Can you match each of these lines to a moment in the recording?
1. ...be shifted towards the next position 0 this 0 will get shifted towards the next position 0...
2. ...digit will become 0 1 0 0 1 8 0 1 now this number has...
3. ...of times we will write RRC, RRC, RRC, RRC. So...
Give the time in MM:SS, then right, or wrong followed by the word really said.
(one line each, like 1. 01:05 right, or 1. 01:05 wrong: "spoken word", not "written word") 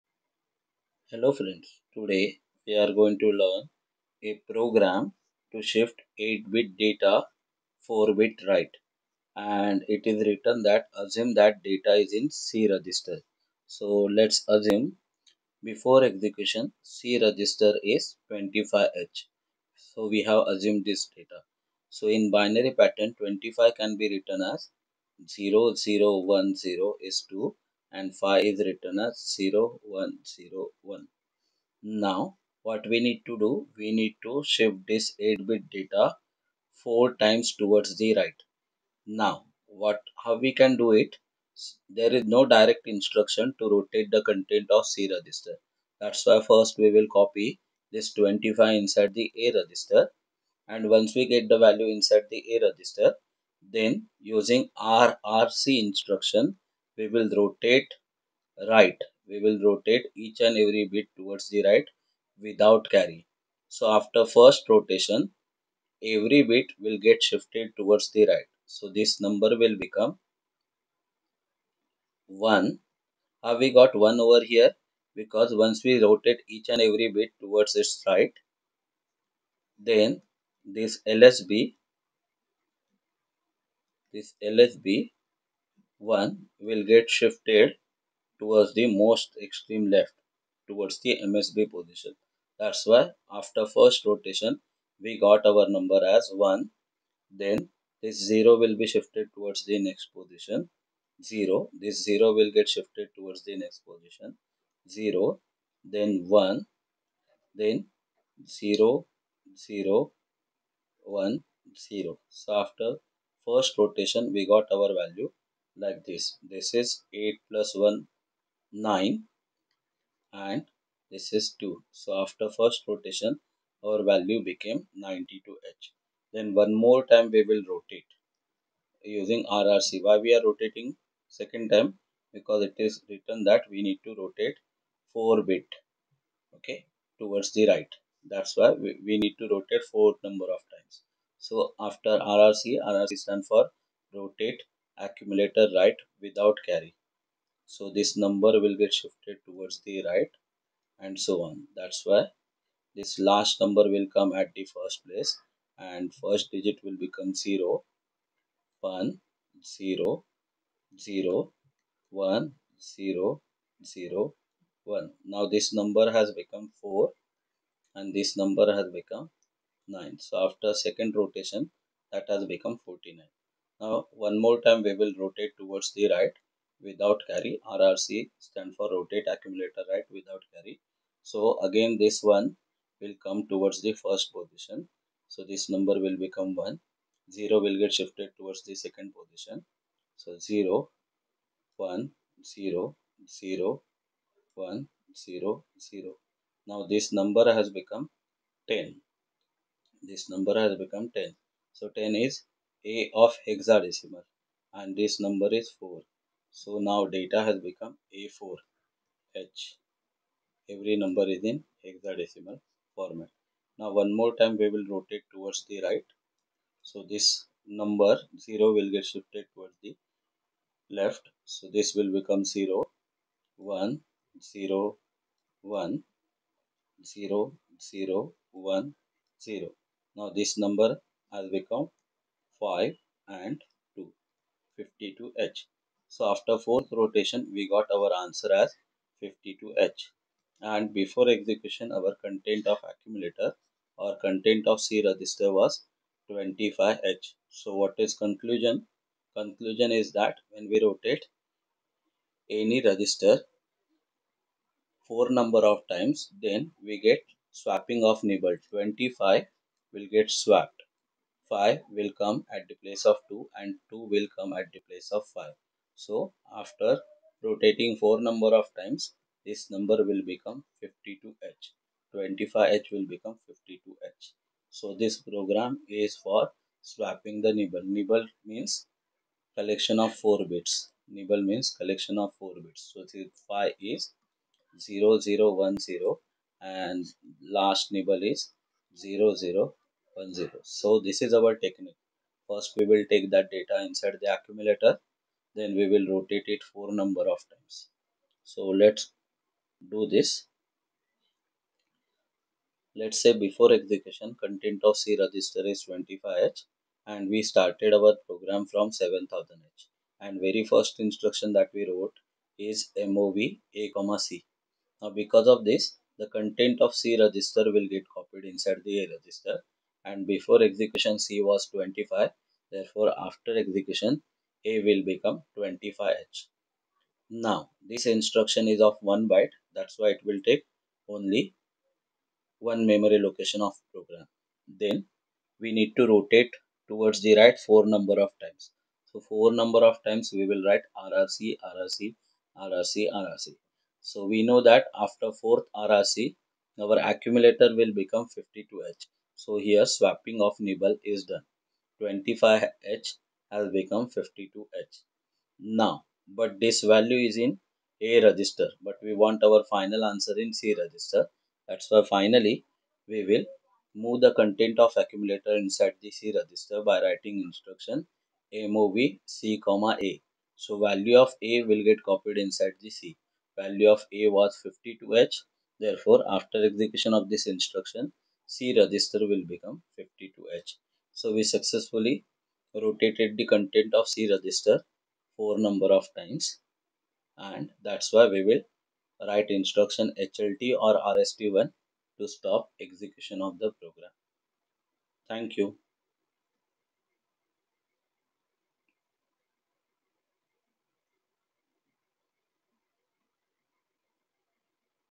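1. 01:38 right
2. 02:36 wrong: "0", not "8"
3. 05:39 right.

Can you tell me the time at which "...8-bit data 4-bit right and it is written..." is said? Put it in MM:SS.
00:06.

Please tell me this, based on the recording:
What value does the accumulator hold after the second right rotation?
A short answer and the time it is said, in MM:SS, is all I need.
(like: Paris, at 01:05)
49, at 02:52.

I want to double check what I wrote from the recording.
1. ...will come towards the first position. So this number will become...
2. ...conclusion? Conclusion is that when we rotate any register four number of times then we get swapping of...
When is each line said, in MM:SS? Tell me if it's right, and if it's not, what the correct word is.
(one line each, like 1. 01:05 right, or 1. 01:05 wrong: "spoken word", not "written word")
1. 03:02 right
2. 04:08 right.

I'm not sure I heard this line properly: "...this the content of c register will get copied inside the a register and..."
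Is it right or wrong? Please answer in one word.
right.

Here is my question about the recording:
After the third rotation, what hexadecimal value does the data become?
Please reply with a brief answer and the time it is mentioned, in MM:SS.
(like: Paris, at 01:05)
A4H, at 03:28.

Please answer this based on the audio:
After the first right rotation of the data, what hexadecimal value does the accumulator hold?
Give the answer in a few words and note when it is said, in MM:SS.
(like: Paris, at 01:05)
92H, at 02:05.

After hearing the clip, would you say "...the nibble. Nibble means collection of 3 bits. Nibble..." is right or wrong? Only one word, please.
wrong.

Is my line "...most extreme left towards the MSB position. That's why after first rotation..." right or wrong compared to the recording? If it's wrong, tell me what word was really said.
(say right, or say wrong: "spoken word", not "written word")
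right.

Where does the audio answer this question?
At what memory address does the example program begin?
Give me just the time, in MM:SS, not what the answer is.
05:08.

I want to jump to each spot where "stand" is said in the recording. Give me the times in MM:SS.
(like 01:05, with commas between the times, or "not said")
02:23, 02:58.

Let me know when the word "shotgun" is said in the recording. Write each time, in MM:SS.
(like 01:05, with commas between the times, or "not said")
not said.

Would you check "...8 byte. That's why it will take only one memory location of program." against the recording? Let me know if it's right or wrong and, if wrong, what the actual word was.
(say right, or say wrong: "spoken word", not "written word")
wrong: "1", not "8".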